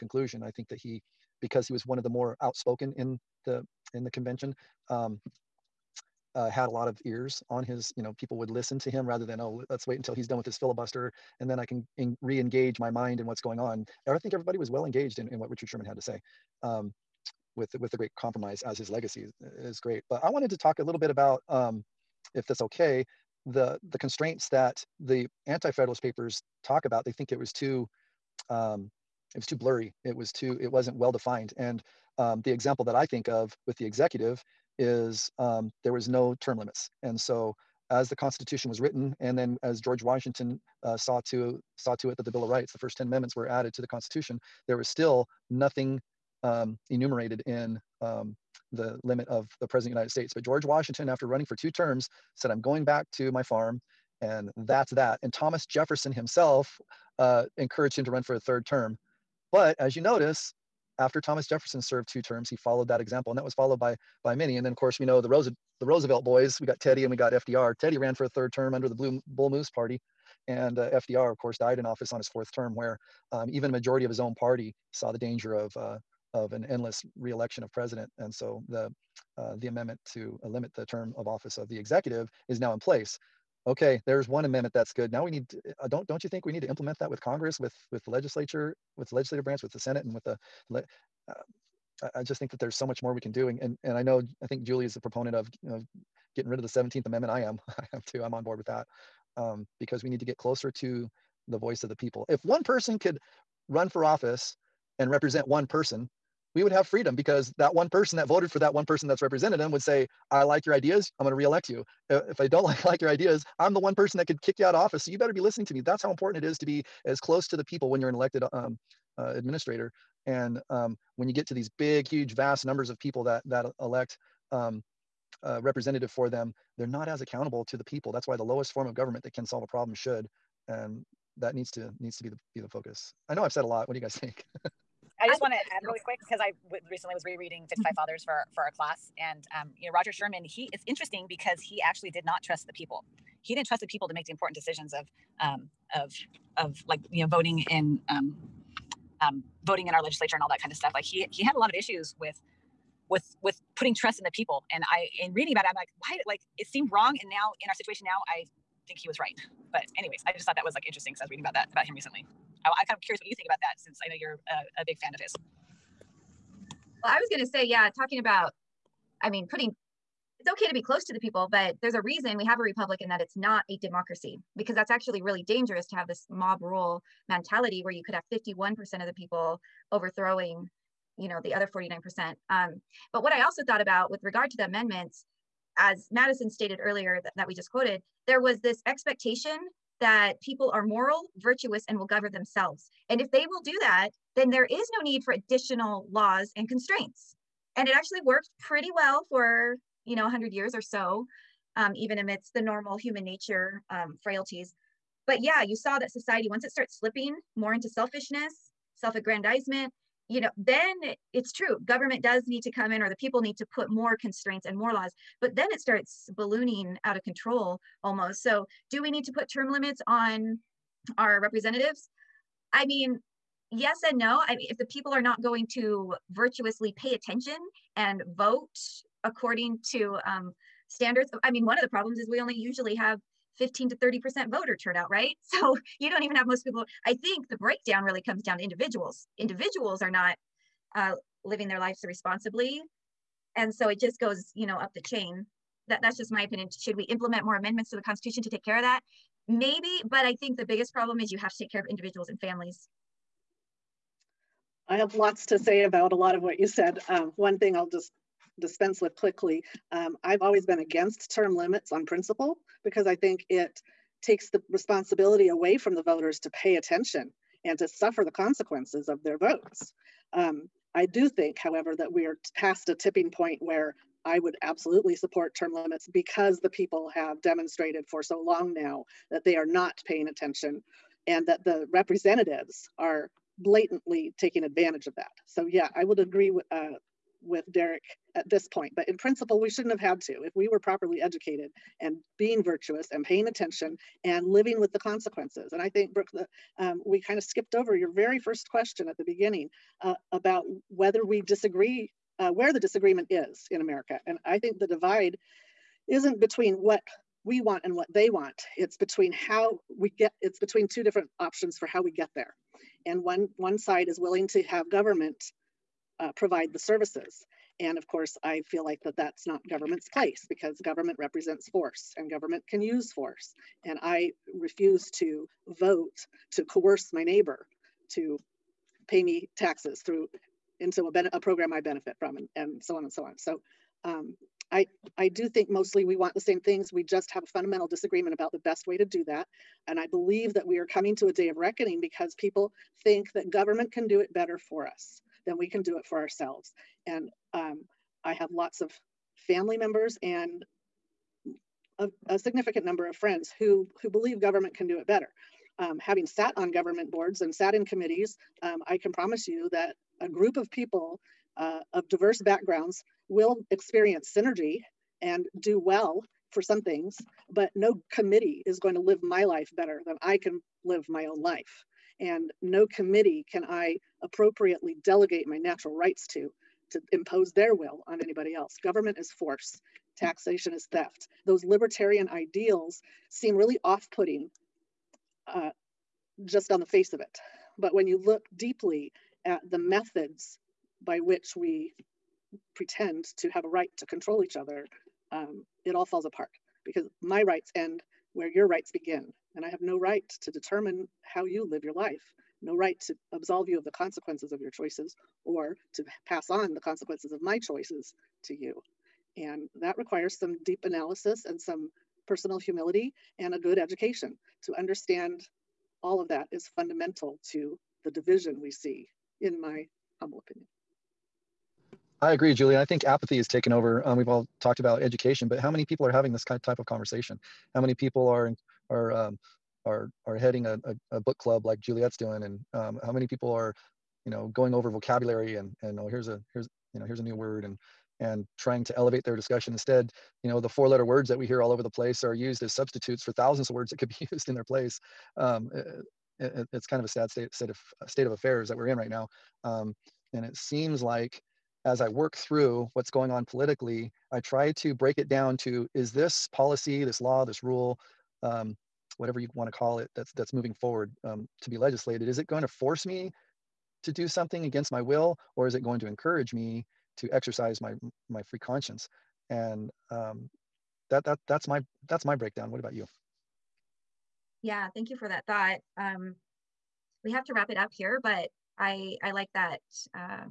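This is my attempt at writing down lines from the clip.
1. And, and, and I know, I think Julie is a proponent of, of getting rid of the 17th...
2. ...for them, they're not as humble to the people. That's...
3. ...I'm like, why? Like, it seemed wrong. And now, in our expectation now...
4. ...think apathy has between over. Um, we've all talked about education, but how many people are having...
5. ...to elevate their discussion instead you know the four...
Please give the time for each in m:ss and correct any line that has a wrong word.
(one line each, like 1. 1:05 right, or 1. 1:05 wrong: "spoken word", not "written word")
1. 1:33 right
2. 2:06 wrong: "accountable", not "humble"
3. 2:35 wrong: "situation", not "expectation"
4. 7:02 wrong: "taken", not "between"
5. 7:18 right.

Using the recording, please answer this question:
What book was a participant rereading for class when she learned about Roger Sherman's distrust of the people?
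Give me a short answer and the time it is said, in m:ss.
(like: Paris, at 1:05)
55 Fathers, at 2:17.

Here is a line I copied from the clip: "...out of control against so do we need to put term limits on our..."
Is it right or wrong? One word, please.
wrong.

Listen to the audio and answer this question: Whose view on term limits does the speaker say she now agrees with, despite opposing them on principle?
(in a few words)
Derek.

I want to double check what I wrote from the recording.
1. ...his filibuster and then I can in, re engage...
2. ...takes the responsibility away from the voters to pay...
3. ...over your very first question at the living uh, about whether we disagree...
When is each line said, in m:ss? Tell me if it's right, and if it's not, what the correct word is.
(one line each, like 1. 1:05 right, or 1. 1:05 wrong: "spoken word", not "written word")
1. 0:10 right
2. 4:24 right
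3. 4:57 wrong: "beginning", not "living".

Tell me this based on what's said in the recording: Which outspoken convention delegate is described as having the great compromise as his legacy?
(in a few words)
Richard Sherman.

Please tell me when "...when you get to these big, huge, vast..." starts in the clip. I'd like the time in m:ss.
2:01.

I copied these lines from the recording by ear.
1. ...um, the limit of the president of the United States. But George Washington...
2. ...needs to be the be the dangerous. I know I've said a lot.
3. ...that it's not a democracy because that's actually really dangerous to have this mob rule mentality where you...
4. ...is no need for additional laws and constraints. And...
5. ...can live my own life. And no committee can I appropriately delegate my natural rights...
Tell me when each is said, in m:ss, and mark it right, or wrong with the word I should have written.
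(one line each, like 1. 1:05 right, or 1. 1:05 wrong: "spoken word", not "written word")
1. 0:48 right
2. 2:11 wrong: "focus", not "dangerous"
3. 2:53 right
4. 3:14 right
5. 6:10 right.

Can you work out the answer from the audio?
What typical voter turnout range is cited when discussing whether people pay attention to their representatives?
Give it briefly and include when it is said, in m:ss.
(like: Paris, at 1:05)
15 to 30%, at 3:53.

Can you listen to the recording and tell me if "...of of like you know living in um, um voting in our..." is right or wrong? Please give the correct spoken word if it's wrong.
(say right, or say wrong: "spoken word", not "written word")
wrong: "voting", not "living".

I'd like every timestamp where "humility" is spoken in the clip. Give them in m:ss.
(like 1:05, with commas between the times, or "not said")
6:52.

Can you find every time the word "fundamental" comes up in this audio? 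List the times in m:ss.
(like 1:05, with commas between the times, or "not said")
5:37, 6:56.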